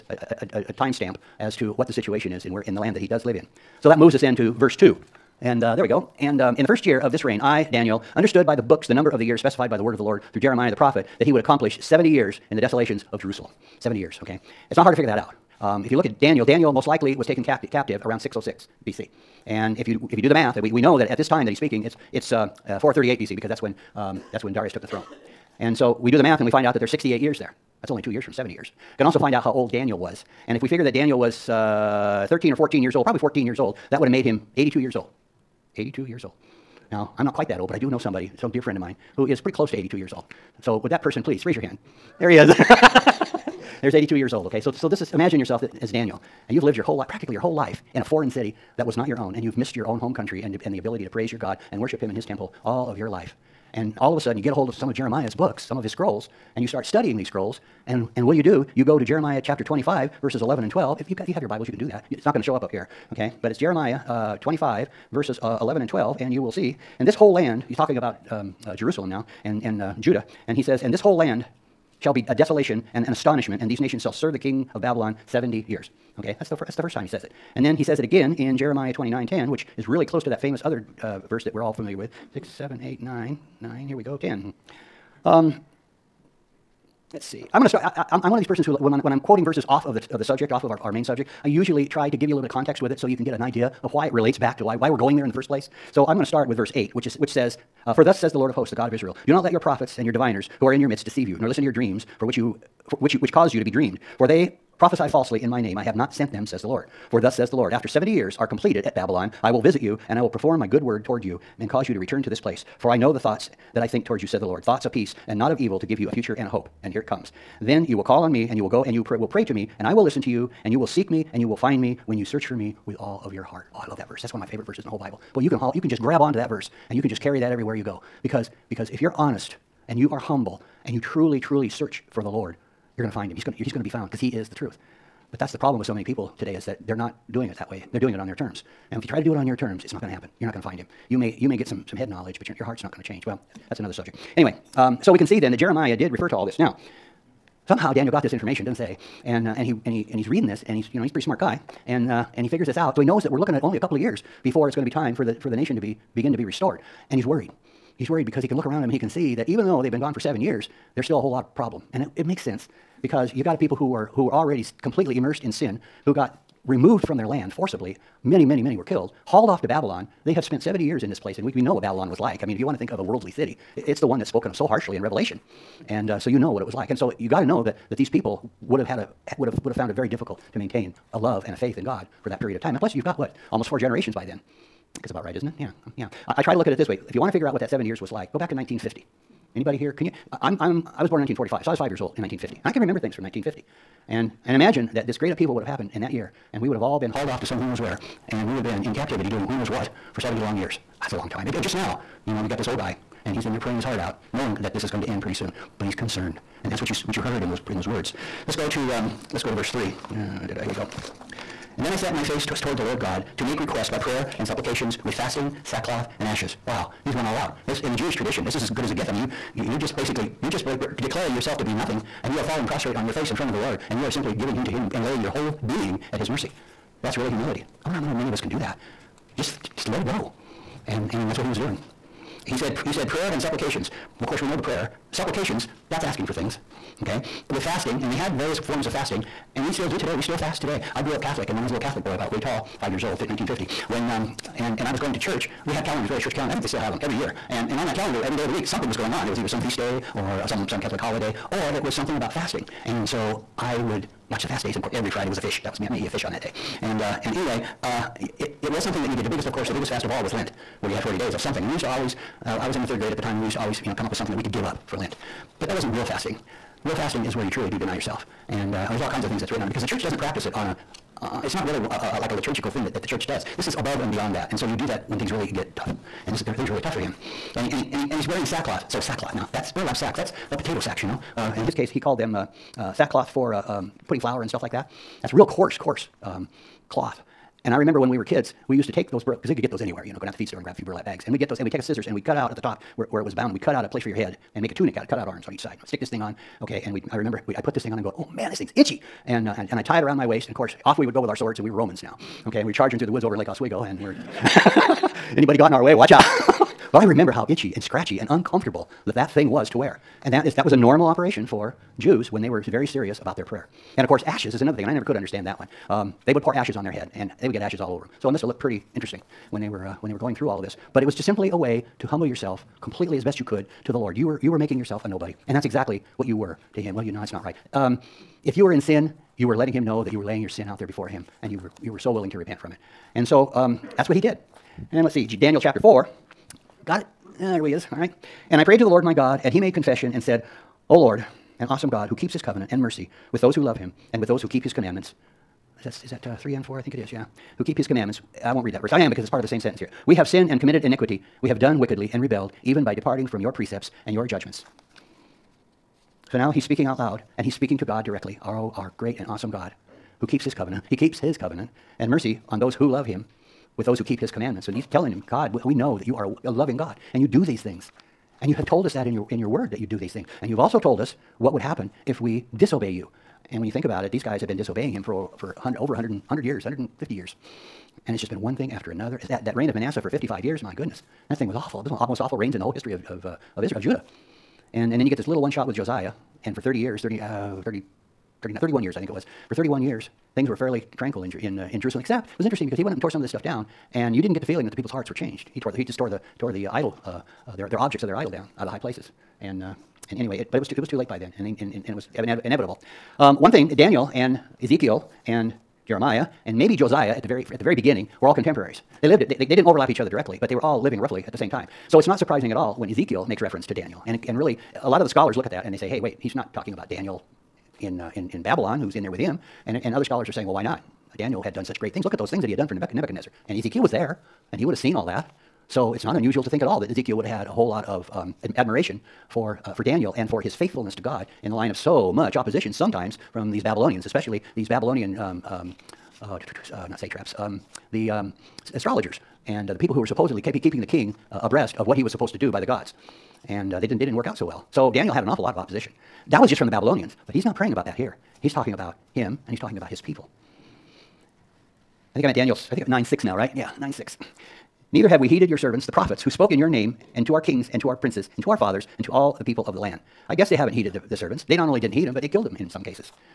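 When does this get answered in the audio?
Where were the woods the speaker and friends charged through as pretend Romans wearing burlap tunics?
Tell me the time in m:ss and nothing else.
5:03.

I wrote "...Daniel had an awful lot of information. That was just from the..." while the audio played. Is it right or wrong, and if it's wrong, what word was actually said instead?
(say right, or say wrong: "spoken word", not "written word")
wrong: "opposition", not "information".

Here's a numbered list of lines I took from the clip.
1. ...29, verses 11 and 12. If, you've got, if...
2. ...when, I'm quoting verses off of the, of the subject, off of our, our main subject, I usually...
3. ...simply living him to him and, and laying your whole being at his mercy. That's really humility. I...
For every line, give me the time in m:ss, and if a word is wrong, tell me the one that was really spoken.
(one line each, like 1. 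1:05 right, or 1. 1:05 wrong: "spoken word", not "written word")
1. 0:59 wrong: "25", not "29"
2. 1:28 right
3. 3:44 wrong: "giving", not "living".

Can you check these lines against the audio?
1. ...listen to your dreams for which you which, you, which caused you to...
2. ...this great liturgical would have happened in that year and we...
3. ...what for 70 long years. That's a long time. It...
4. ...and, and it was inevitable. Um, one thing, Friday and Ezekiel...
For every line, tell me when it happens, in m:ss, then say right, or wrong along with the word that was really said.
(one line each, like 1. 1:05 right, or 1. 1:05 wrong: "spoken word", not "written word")
1. 1:41 right
2. 3:15 wrong: "upheaval", not "liturgical"
3. 3:19 right
4. 6:41 wrong: "Daniel", not "Friday".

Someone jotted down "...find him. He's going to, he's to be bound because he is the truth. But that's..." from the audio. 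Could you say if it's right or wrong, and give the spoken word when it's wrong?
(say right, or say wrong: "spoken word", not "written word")
wrong: "found", not "bound".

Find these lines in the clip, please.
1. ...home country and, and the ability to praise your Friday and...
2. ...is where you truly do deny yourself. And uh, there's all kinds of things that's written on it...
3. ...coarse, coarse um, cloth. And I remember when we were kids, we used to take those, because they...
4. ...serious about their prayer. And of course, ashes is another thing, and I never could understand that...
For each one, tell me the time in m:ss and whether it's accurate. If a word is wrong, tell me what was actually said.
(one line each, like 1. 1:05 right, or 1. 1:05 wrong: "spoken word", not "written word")
1. 0:49 wrong: "God", not "Friday"
2. 4:27 right
3. 4:45 right
4. 5:12 right.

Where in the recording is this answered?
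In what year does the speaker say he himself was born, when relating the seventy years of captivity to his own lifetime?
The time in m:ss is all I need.
3:11.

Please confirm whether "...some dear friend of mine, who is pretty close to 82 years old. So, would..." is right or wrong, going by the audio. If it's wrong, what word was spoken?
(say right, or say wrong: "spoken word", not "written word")
right.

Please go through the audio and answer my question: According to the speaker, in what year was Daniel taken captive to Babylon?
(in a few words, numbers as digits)
606 BC.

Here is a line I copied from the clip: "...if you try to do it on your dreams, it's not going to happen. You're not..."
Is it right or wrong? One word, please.
wrong.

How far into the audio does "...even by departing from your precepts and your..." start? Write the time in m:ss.
5:52.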